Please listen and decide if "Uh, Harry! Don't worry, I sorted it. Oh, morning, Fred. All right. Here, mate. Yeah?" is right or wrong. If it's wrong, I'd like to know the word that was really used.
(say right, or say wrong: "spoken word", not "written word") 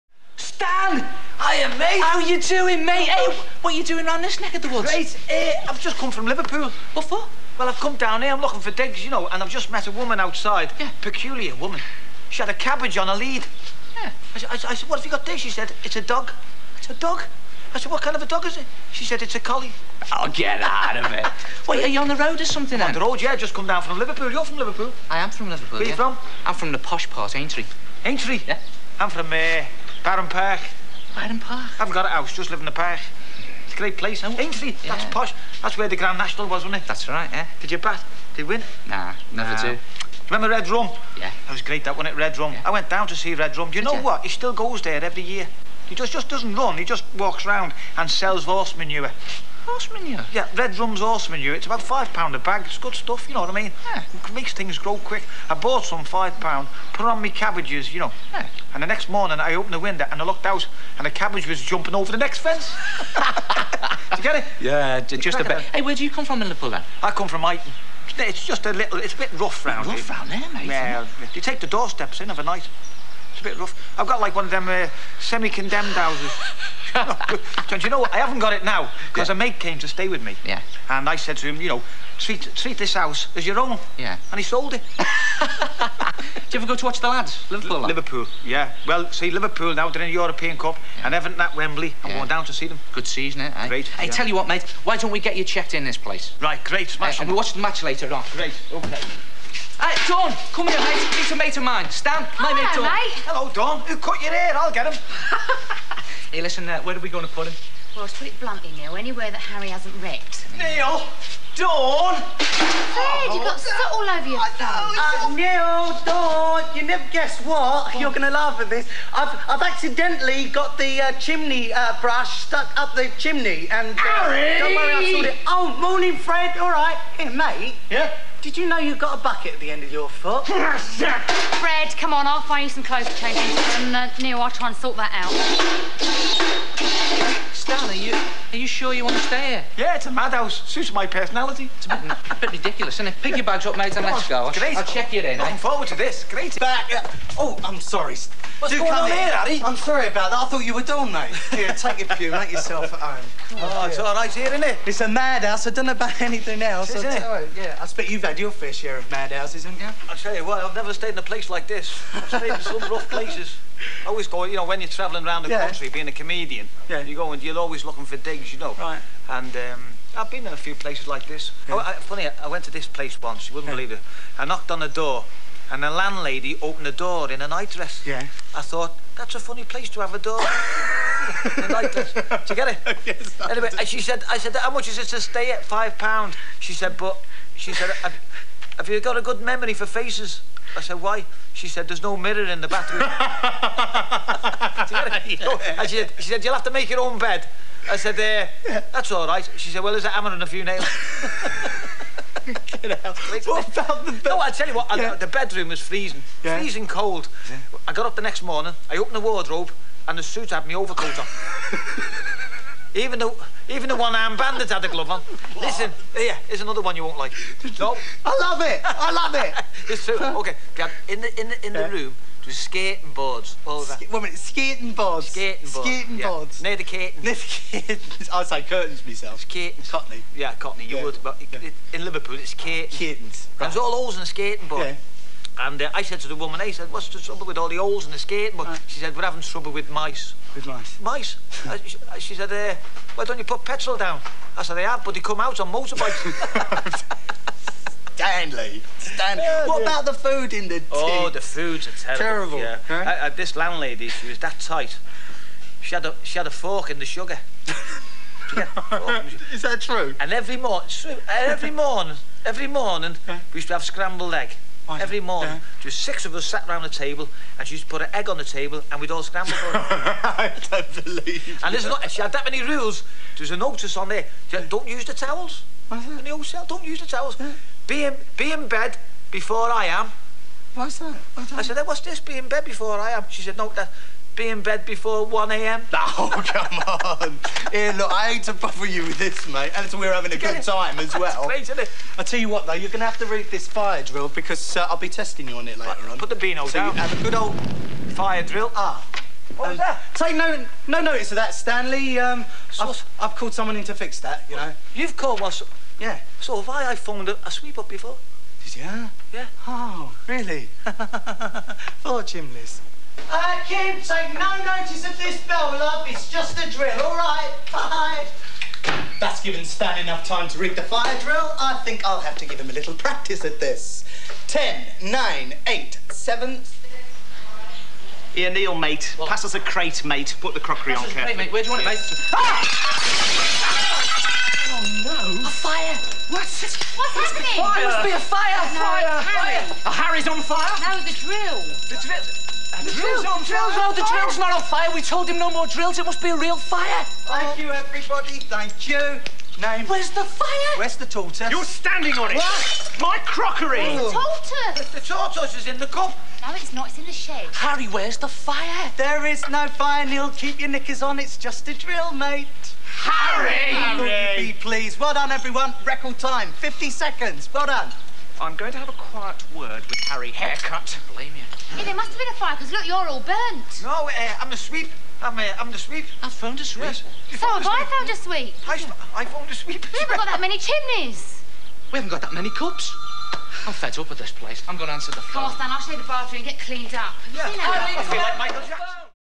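right.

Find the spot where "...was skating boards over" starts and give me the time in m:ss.
3:42.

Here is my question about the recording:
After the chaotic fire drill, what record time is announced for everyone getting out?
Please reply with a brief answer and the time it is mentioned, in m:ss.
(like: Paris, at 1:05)
50 seconds, at 6:06.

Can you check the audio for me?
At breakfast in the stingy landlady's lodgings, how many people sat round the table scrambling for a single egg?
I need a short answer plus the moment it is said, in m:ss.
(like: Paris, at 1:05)
6, at 4:25.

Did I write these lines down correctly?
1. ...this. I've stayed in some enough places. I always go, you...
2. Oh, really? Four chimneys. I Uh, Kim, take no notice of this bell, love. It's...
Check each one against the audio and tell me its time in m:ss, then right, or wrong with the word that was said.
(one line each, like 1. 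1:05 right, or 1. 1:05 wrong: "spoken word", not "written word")
1. 2:41 wrong: "rough", not "enough"
2. 5:09 right.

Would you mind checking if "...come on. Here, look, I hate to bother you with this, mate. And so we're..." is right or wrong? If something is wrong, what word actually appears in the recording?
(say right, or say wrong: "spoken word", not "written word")
right.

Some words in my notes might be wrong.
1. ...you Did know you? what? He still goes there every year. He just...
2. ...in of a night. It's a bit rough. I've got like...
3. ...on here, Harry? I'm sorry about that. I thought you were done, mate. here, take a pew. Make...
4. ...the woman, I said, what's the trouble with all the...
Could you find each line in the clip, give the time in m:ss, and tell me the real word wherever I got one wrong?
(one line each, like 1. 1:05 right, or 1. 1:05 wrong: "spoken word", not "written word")
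1. 0:43 right
2. 1:12 right
3. 2:28 right
4. 3:56 right.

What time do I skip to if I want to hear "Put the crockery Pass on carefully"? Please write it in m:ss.
5:30.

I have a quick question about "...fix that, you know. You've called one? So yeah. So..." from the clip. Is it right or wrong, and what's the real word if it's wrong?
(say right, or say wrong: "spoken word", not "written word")
right.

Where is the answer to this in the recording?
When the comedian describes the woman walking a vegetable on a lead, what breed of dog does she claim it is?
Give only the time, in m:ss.
0:19.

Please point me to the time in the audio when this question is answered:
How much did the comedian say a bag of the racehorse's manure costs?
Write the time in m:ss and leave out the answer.
0:51.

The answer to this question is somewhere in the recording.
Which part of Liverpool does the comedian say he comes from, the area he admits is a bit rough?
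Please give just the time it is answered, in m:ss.
1:07.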